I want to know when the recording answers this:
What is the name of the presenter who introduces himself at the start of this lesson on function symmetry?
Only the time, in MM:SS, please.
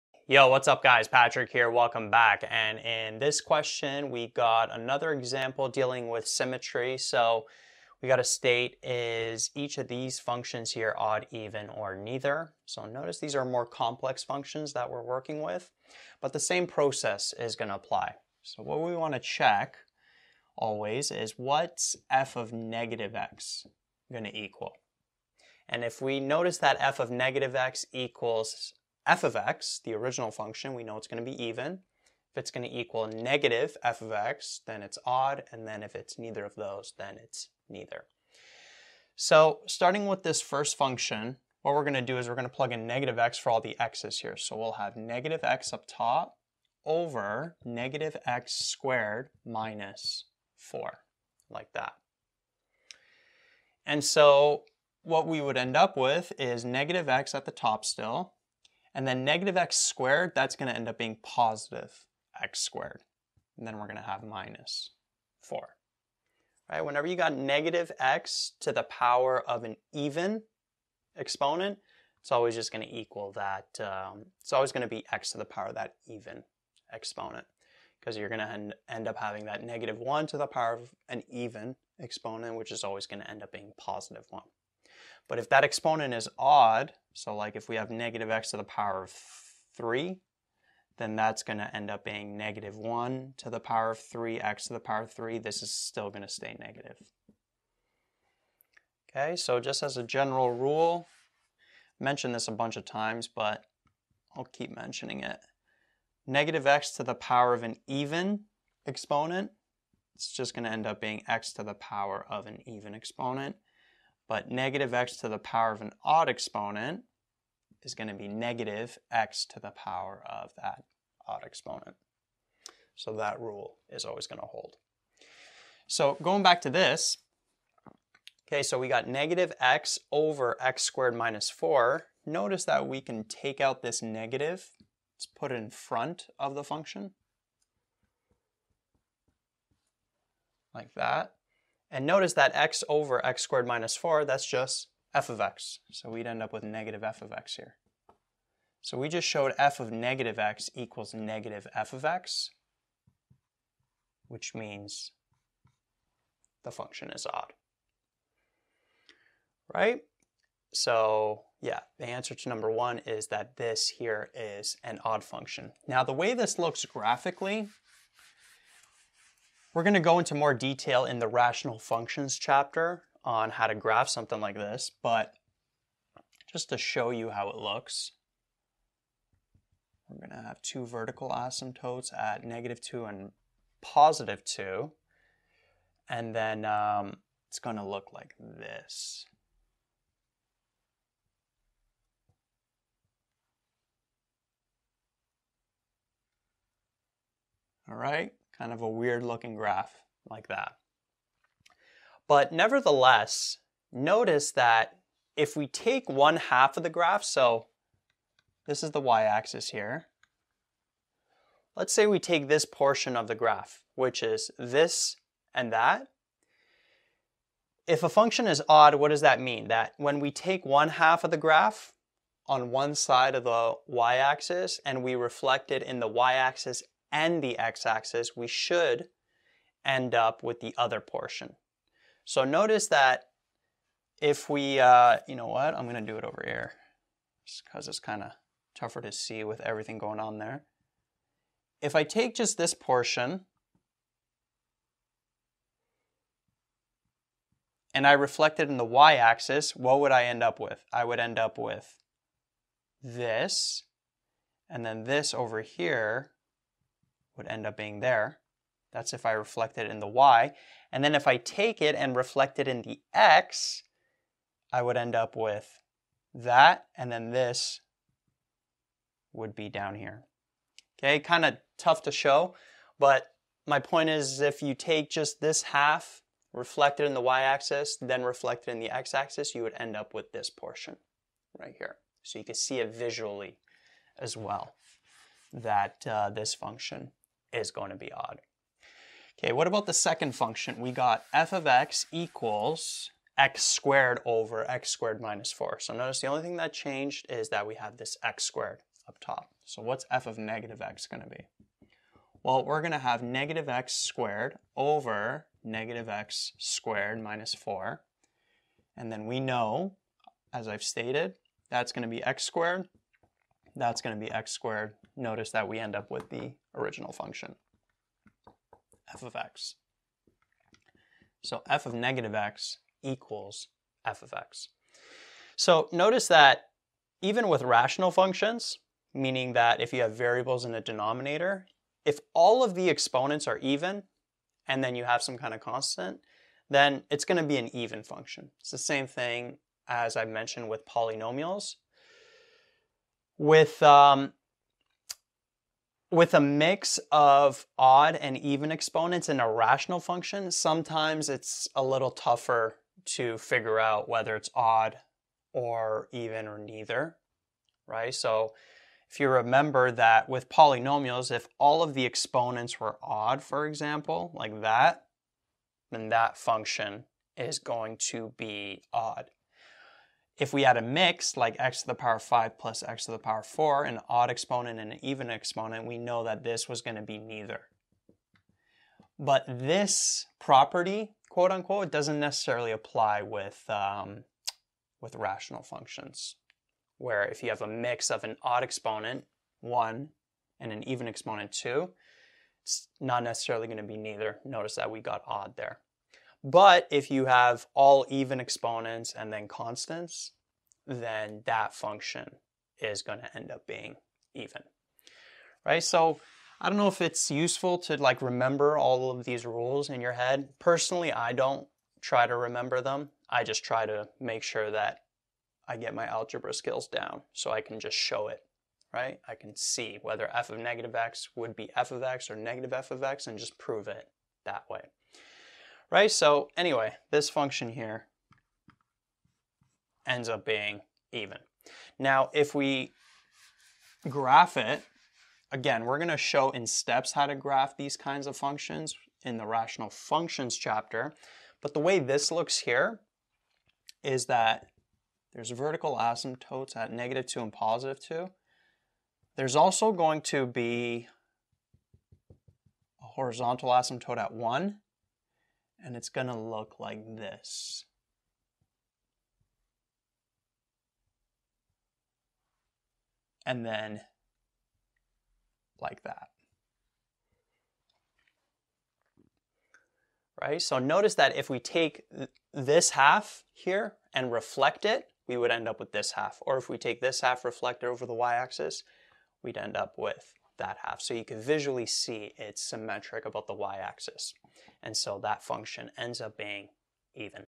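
00:01.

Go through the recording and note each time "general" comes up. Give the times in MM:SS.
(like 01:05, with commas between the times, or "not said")
01:40.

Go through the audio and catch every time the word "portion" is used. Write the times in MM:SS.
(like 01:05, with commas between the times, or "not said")
03:32, 03:51, 04:02, 04:40.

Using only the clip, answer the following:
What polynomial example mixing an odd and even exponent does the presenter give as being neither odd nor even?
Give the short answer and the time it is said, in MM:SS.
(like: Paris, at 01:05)
x^5 + x^4, at 06:11.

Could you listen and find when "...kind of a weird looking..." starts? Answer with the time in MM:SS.
03:18.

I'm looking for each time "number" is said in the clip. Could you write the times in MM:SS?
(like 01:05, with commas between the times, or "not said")
02:42.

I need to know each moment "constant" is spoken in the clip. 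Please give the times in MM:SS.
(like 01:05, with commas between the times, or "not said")
05:35, 06:39.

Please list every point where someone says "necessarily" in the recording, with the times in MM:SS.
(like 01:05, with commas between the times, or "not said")
06:22, 06:33.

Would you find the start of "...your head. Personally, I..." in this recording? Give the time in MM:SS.
06:50.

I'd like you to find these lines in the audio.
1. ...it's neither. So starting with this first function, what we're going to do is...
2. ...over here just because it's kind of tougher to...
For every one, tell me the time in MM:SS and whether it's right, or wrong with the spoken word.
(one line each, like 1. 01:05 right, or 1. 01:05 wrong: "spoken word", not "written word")
1. 00:37 right
2. 03:56 right.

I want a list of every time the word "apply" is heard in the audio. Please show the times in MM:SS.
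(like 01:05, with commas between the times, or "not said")
00:17, 06:22.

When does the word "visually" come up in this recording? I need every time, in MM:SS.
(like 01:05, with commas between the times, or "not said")
04:42, 08:01.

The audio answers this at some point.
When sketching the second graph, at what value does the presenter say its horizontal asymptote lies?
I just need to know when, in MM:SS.
07:34.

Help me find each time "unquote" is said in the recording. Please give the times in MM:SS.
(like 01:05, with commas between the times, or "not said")
06:21.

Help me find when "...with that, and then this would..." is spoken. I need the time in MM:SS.
04:25.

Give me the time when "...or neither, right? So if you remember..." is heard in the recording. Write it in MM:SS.
05:56.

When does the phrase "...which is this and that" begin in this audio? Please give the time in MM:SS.
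03:33.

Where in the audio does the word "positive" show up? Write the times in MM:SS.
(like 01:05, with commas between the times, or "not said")
01:01, 01:23, 03:03, 07:27.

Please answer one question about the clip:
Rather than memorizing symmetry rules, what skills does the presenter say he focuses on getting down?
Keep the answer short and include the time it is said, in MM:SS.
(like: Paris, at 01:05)
algebra skills, at 06:56.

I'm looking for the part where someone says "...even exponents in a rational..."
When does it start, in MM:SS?
05:48.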